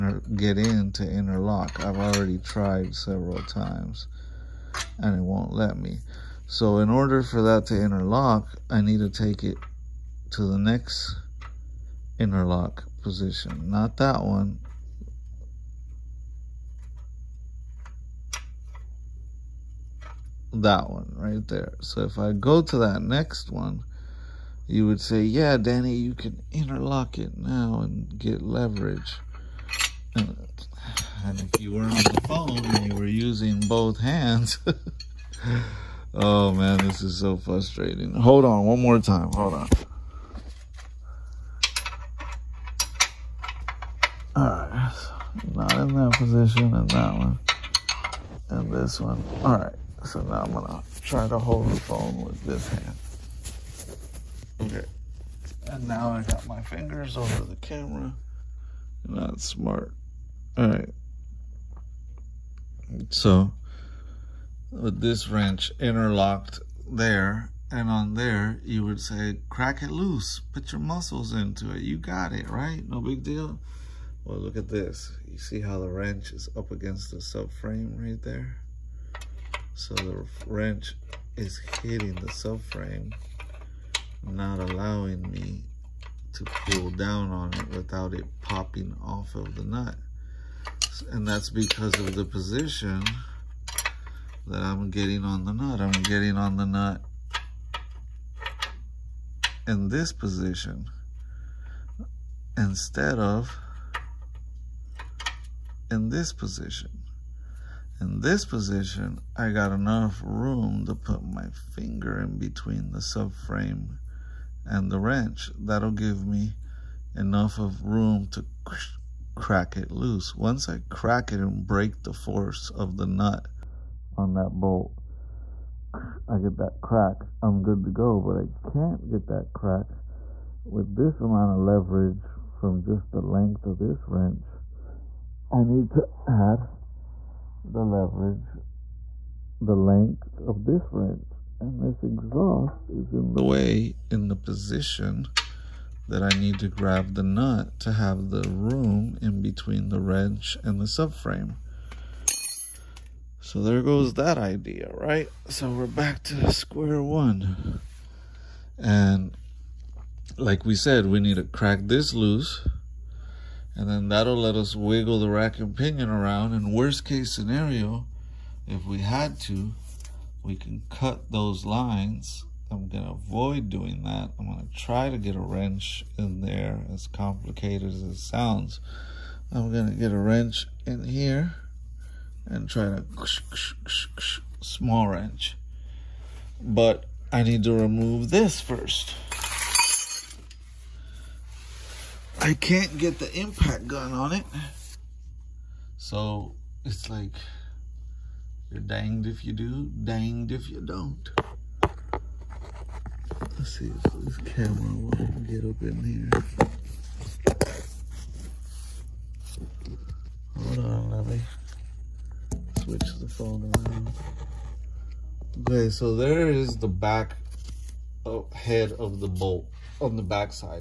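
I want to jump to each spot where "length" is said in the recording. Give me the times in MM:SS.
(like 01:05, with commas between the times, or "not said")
02:13, 02:19.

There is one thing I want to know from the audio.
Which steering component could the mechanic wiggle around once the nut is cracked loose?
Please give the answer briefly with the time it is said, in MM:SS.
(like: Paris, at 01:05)
Rack and pinion, at 02:45.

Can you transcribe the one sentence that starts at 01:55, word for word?
That'll give me enough of room to crack it loose.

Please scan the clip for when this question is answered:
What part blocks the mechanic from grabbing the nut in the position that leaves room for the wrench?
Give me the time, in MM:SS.
02:22.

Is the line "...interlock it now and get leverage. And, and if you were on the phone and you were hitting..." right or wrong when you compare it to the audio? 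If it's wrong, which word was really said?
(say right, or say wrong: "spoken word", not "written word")
wrong: "using", not "hitting".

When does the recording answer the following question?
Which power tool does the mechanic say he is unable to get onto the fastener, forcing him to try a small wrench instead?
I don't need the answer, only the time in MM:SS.
03:13.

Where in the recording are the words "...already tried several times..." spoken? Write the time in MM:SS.
00:01.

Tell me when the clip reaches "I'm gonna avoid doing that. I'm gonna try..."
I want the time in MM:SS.
02:52.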